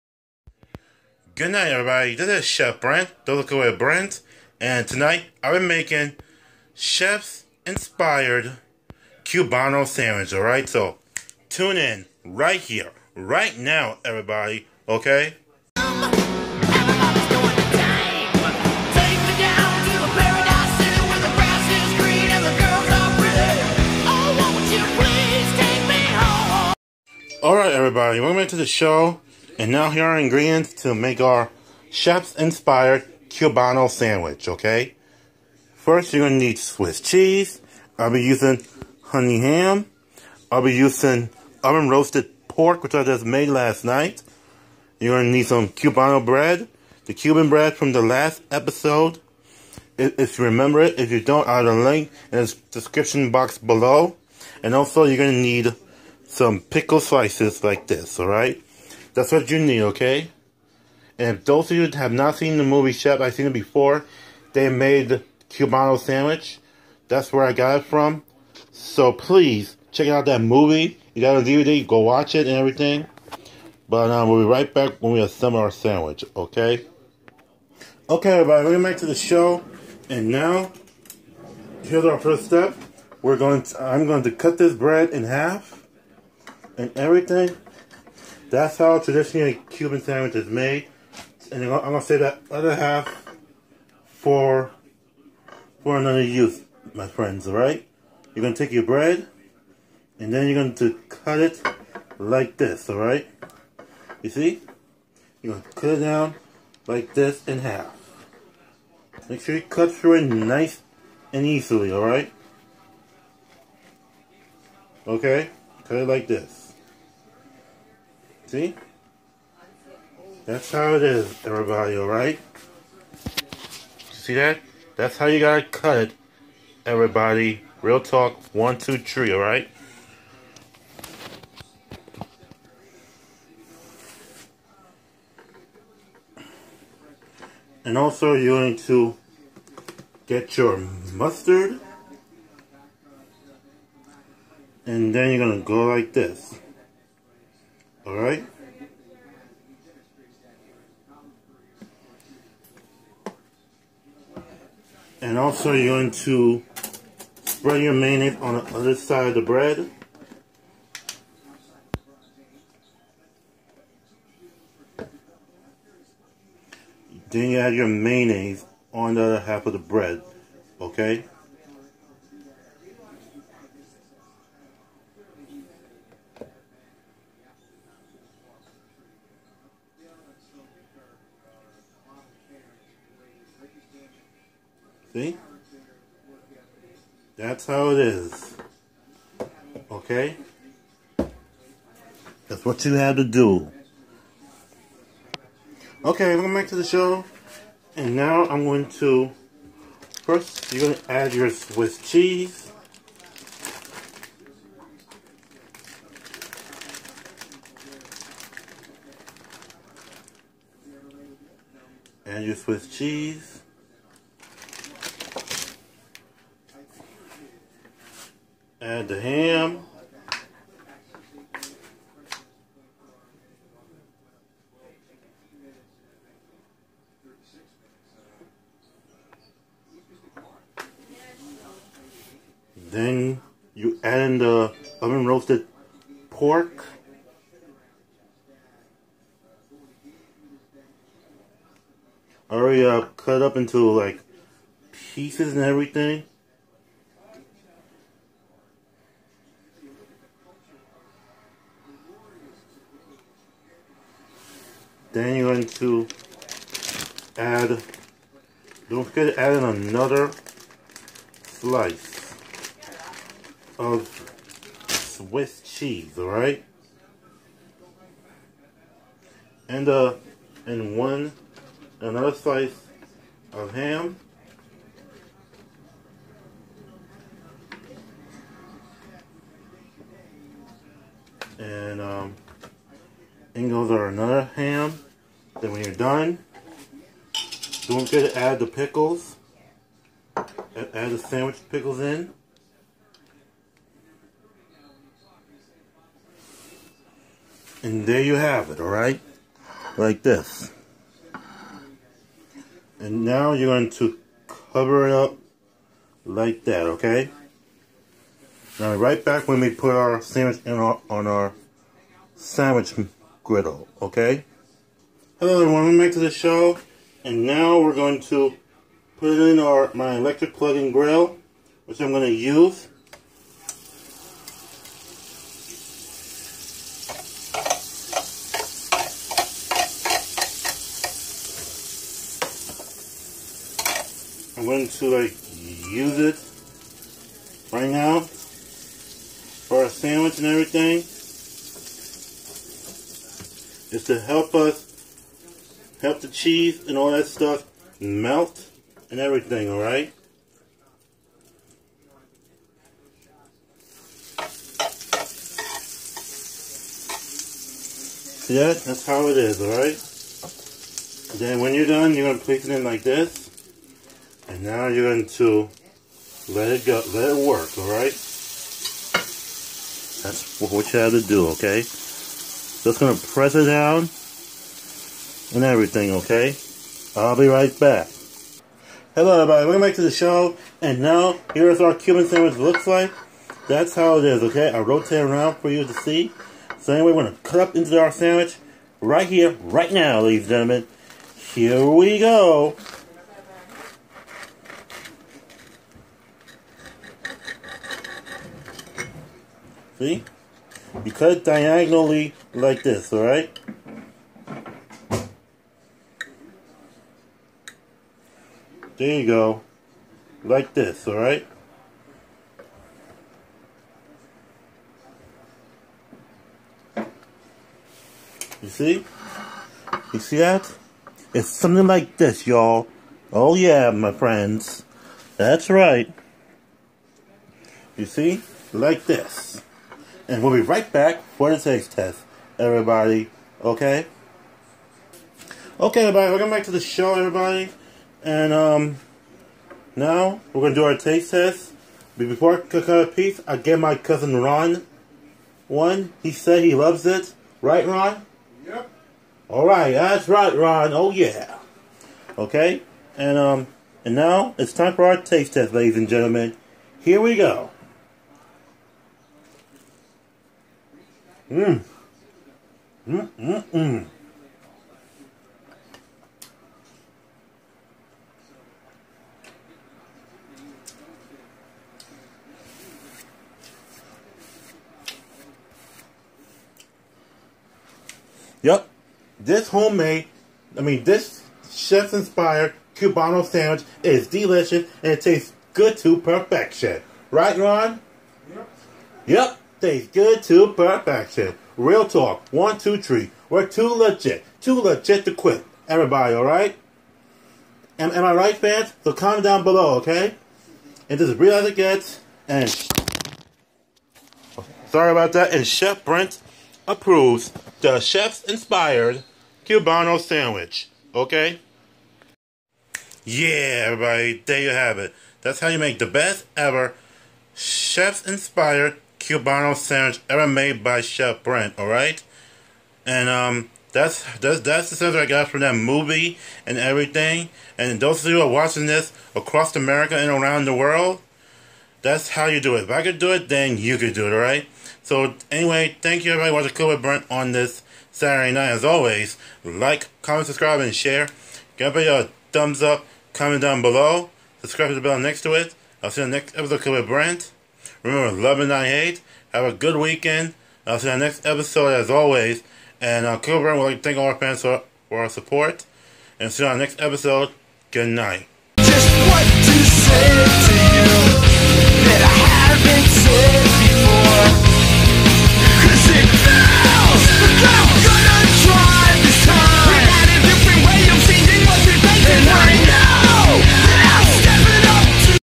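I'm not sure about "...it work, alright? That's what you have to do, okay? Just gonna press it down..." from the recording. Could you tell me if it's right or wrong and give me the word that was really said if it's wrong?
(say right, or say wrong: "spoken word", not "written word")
right.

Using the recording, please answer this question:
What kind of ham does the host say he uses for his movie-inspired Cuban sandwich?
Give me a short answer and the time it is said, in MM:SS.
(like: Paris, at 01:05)
honey ham, at 00:39.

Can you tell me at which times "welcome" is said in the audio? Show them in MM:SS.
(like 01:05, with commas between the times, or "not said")
00:28, 05:15, 06:19, 07:16.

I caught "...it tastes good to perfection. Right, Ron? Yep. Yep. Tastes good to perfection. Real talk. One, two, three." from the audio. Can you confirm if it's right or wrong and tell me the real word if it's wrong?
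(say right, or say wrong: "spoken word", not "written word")
right.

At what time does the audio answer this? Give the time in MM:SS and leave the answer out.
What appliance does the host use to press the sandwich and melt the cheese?
05:20.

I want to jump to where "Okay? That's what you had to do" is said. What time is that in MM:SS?
03:09.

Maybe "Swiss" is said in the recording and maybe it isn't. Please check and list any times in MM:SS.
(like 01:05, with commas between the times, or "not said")
00:36, 03:21, 03:32, 04:24.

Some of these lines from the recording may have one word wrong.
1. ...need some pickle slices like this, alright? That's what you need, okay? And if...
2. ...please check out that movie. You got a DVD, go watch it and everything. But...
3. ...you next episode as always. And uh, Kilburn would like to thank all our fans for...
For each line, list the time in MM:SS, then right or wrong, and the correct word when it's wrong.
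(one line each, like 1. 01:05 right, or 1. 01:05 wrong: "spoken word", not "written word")
1. 00:55 right
2. 01:09 right
3. 09:11 right.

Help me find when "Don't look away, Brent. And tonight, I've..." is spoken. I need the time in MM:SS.
00:03.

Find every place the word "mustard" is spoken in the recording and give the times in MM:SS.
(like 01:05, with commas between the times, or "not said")
02:21.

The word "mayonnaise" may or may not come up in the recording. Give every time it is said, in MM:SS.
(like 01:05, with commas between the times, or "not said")
02:37, 02:47.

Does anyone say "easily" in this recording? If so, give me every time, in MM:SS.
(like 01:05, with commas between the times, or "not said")
01:51.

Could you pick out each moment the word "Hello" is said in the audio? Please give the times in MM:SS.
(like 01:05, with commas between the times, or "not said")
05:15, 06:19.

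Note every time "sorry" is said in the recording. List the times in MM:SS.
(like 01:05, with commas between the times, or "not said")
08:24.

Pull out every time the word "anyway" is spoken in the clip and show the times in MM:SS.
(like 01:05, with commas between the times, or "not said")
06:26, 08:55.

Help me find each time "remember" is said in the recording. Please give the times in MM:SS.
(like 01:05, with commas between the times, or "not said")
00:50, 09:08.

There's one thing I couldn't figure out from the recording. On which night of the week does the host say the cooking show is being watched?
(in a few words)
Saturday.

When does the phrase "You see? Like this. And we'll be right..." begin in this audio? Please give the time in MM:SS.
07:07.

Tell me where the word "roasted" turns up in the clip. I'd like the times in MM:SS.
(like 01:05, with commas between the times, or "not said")
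00:41, 03:55.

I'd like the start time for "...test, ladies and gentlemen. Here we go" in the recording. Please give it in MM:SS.
07:35.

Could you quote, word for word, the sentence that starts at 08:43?
And um that's that's that's the sense I got from that movie and everything.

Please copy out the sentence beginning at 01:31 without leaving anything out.
And I'm going to save that other half for, for another use, my friends, alright?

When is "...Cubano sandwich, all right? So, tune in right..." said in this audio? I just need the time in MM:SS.
00:09.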